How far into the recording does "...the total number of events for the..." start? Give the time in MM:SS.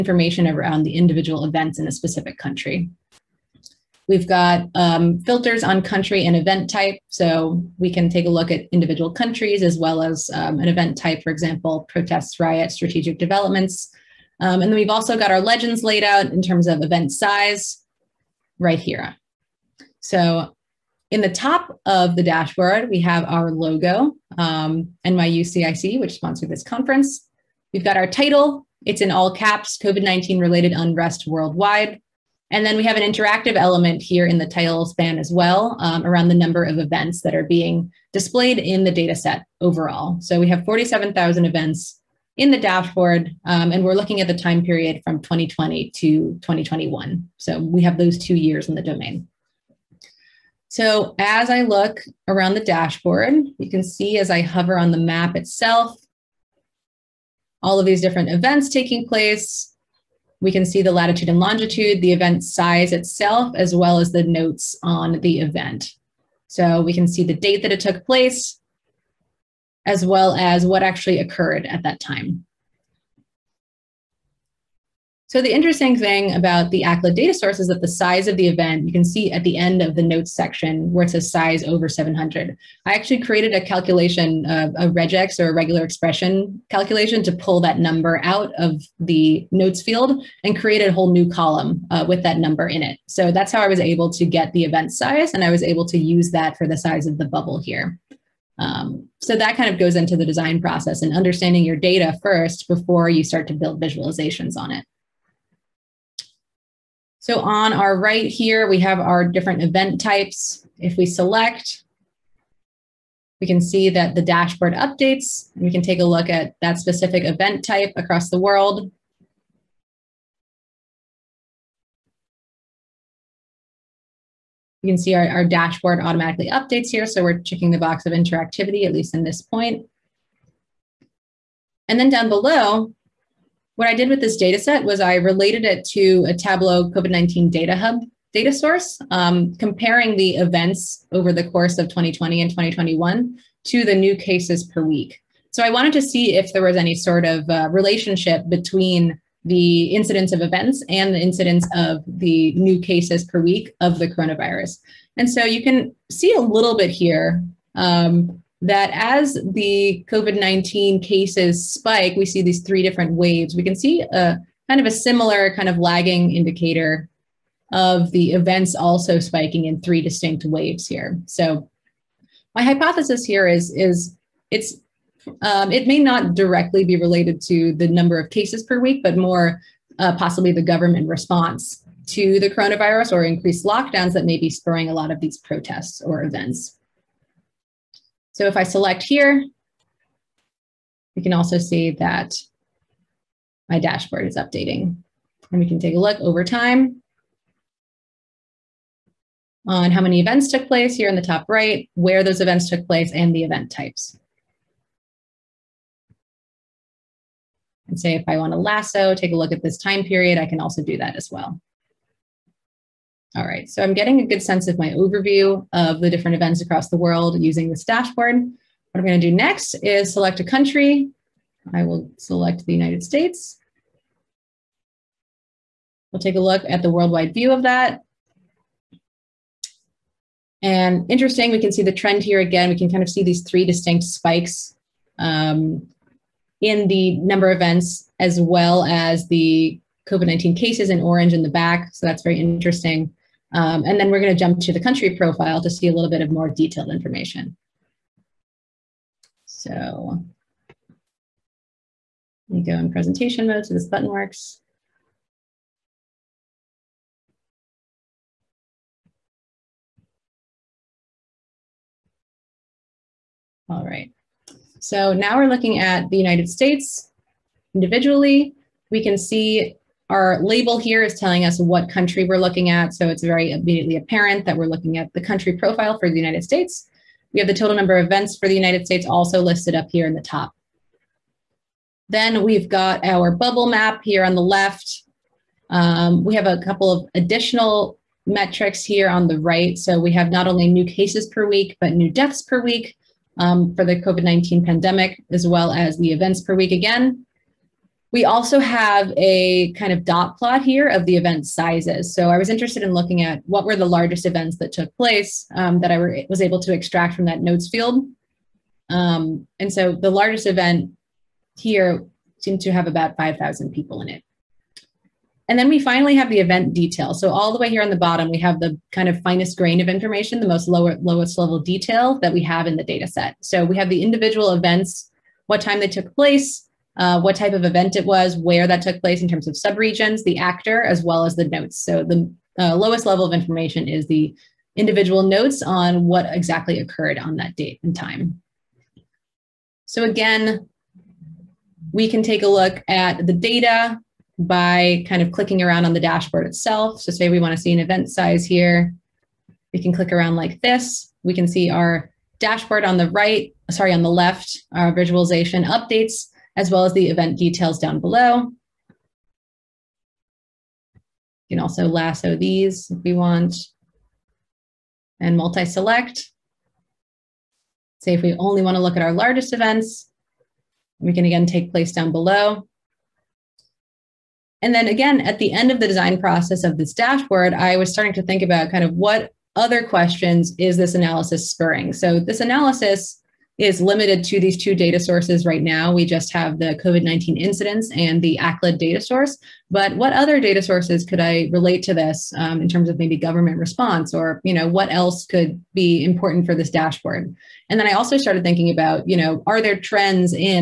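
04:37.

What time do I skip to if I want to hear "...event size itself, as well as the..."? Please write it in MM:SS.
01:02.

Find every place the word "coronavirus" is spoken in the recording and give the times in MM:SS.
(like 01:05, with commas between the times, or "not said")
02:34, 03:02.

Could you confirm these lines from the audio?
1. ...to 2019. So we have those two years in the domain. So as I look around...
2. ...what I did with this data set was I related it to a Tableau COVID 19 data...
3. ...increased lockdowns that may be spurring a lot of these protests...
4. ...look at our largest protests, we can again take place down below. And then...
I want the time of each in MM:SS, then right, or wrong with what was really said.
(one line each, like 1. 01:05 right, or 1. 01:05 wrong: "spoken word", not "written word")
1. 00:45 wrong: "2021", not "2019"
2. 02:13 right
3. 03:03 right
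4. 06:08 wrong: "events", not "protests".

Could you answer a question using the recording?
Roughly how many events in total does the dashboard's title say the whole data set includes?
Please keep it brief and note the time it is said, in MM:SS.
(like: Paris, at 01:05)
47,000, at 00:40.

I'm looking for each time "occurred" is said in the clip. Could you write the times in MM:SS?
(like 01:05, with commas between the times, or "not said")
01:11, 05:36.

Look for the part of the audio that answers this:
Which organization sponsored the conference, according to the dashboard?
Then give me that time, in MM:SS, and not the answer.
00:25.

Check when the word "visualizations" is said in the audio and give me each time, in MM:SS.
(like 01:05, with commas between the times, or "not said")
01:43, 05:54.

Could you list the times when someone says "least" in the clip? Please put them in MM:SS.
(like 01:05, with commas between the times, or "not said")
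02:08.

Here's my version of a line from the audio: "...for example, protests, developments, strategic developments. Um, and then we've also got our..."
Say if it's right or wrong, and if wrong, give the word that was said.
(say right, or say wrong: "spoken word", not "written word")
wrong: "riots", not "developments".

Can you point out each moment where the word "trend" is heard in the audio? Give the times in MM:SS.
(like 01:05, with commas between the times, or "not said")
03:51, 06:39.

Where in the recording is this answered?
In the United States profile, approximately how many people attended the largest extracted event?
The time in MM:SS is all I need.
05:13.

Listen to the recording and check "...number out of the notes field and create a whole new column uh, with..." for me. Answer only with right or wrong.
right.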